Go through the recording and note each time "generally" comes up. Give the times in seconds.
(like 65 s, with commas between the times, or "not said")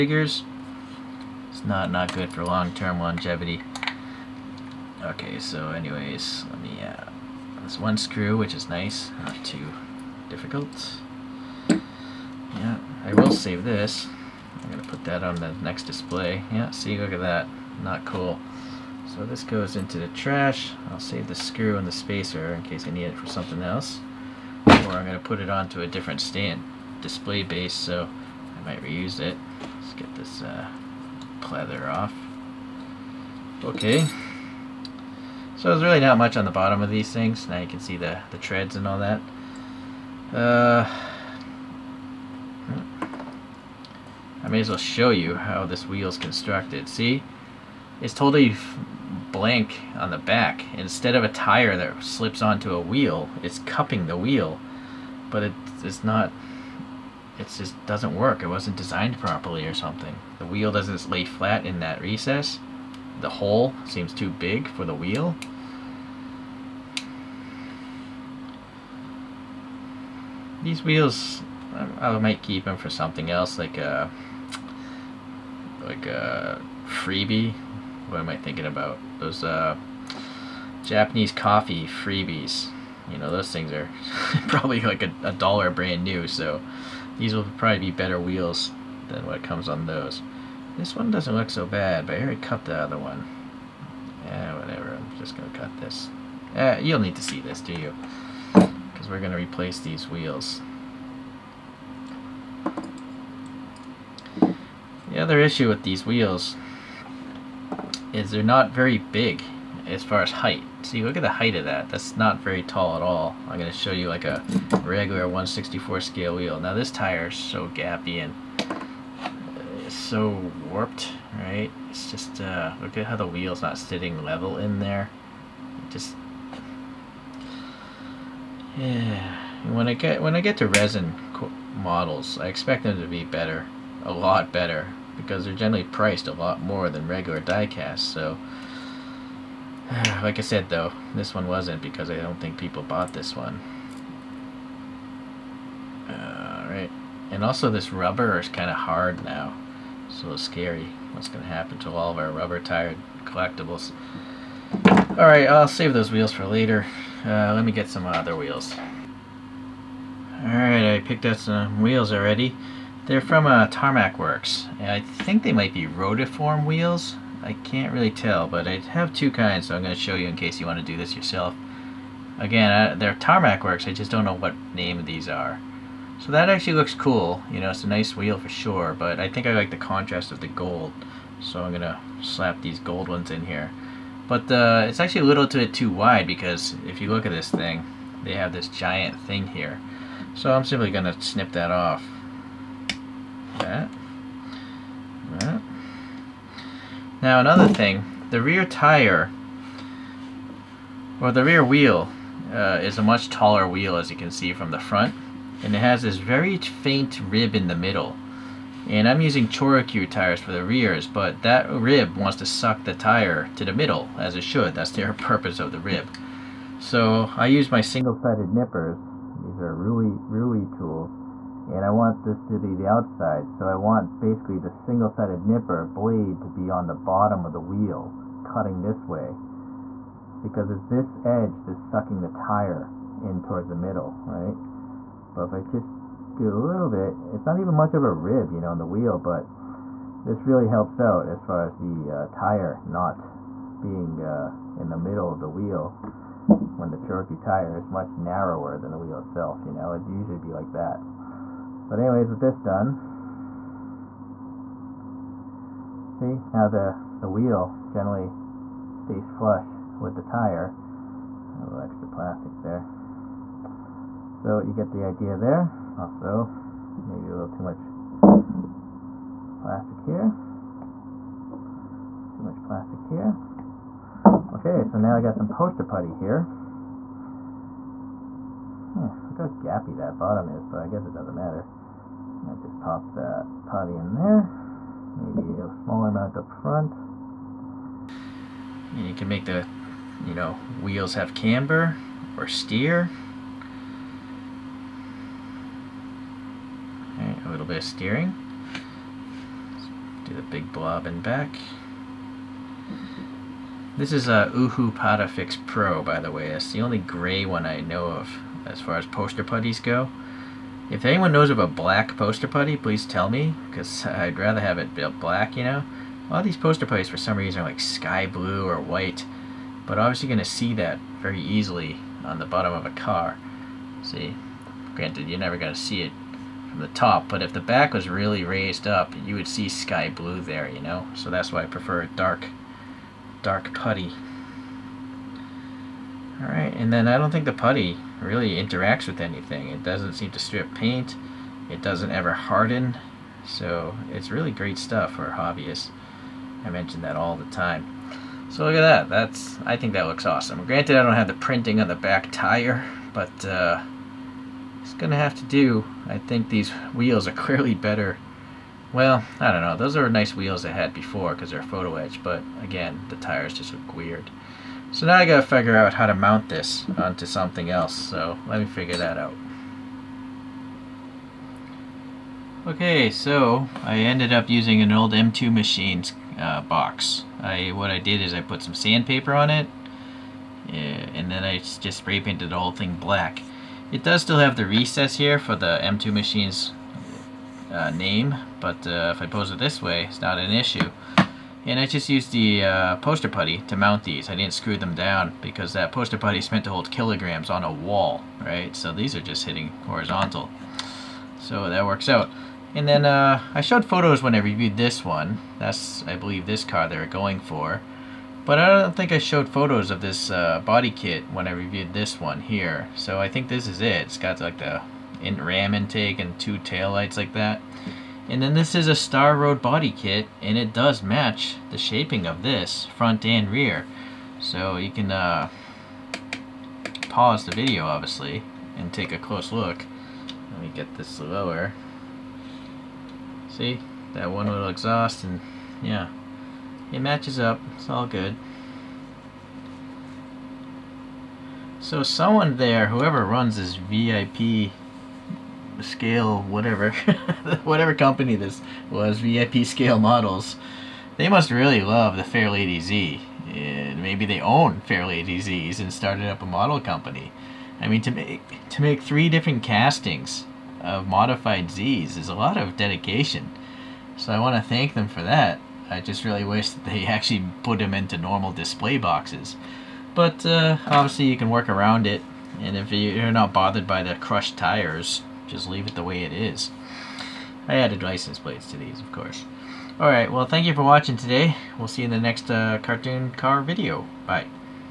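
135 s, 257 s.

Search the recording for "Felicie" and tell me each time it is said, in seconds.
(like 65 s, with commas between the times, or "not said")
not said.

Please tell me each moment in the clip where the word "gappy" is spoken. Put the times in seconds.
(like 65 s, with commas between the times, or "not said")
117 s, 279 s.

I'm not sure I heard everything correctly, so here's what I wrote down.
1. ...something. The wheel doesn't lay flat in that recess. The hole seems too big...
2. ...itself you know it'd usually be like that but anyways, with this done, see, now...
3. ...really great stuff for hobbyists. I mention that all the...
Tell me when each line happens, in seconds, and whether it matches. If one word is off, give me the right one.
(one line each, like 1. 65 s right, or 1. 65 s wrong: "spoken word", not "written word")
1. 59 s right
2. 249 s right
3. 344 s right.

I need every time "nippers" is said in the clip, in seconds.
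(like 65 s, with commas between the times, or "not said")
218 s, 225 s.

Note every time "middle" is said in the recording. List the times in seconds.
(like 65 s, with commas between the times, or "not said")
207 s, 213 s, 233 s, 244 s.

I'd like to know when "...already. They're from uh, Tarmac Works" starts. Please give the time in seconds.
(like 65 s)
162 s.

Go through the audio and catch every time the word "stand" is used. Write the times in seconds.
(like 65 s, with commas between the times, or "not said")
26 s.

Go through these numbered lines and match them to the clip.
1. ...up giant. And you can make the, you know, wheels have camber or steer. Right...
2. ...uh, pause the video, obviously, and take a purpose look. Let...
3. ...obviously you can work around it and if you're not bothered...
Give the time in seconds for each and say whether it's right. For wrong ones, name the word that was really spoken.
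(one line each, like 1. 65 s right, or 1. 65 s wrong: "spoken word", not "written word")
1. 286 s wrong: "front", not "giant"
2. 425 s wrong: "close", not "purpose"
3. 470 s right.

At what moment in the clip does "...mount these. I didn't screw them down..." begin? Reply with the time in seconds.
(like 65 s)
393 s.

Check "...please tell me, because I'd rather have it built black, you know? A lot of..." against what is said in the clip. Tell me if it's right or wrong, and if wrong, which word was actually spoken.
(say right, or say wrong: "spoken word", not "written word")
right.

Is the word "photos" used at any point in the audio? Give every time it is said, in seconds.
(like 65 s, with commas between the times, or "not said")
361 s, 403 s, 409 s.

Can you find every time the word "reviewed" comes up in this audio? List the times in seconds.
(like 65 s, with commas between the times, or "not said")
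404 s, 411 s.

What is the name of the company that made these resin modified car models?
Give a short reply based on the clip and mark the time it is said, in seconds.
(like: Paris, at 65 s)
VIP Scale Models, at 449 s.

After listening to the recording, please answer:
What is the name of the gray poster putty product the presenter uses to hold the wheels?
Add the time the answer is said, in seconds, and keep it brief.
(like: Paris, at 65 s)
Uhu Patafix Pro, at 304 s.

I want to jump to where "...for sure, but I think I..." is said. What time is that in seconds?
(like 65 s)
178 s.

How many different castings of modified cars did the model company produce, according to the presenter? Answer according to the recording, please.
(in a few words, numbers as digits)
3.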